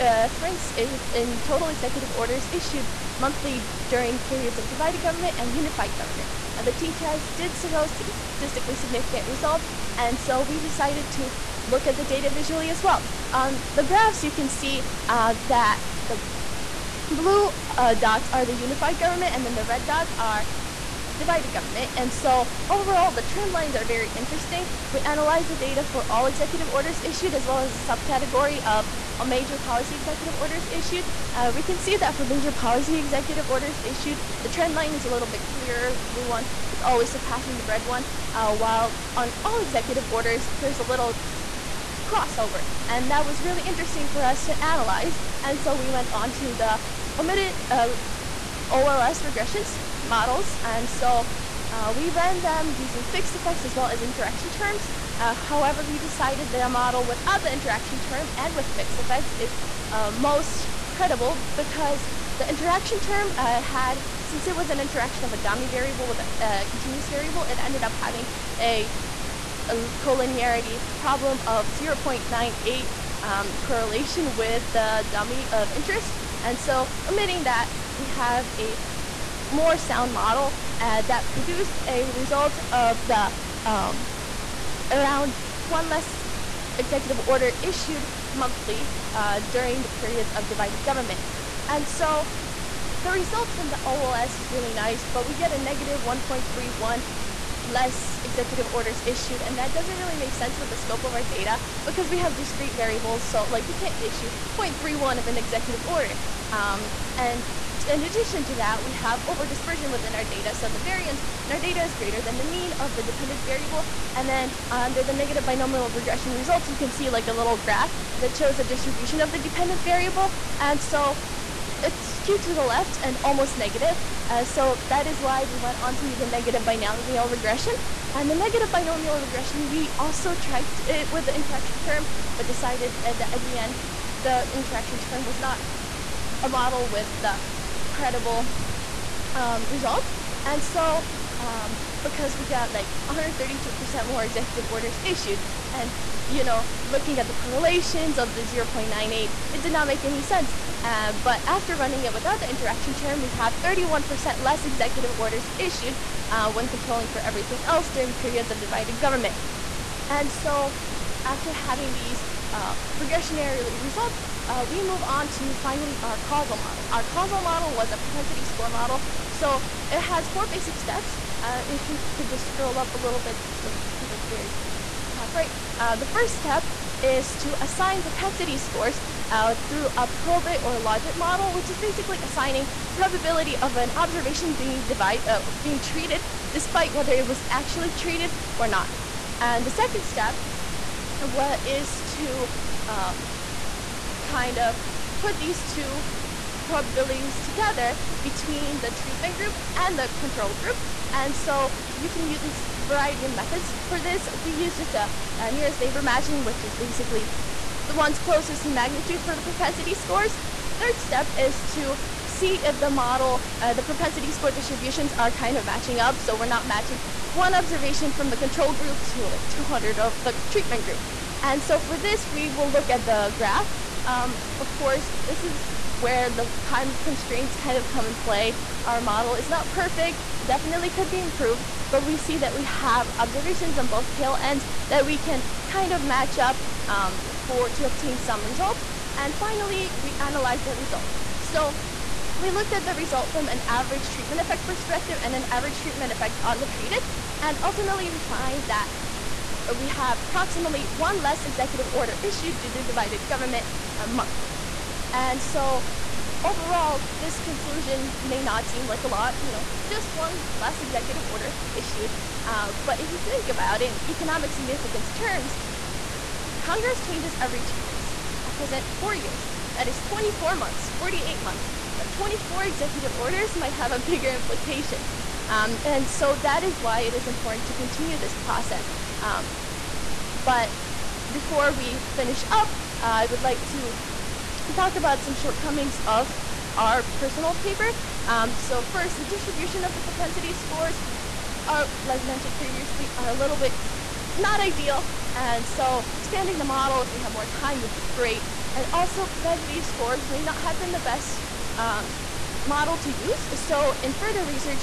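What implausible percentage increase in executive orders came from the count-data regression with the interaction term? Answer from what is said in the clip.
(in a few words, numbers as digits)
132%.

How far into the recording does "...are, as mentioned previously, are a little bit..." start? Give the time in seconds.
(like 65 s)
291 s.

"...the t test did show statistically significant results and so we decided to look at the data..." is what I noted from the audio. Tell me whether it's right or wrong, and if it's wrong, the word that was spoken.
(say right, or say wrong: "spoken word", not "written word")
right.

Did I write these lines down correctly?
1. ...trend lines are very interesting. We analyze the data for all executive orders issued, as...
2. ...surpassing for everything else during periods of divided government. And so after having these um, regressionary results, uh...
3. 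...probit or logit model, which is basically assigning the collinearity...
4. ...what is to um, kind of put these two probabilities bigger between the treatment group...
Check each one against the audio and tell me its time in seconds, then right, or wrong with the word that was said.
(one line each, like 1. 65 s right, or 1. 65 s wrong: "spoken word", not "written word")
1. 23 s right
2. 156 s wrong: "controlling", not "surpassing"
3. 180 s wrong: "probability", not "collinearity"
4. 191 s wrong: "together", not "bigger".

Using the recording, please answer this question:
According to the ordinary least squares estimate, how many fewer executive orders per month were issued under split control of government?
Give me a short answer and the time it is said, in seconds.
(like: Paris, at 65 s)
1.31, at 96 s.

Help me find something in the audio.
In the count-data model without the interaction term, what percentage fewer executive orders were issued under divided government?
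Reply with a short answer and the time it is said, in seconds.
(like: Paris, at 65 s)
31%, at 153 s.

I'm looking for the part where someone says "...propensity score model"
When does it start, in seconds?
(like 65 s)
167 s.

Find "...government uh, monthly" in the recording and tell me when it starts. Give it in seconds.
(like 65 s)
253 s.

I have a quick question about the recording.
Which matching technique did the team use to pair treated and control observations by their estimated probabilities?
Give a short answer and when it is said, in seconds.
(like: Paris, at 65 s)
nearest neighbor matching, at 205 s.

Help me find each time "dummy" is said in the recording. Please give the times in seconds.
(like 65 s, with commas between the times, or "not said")
65 s, 75 s.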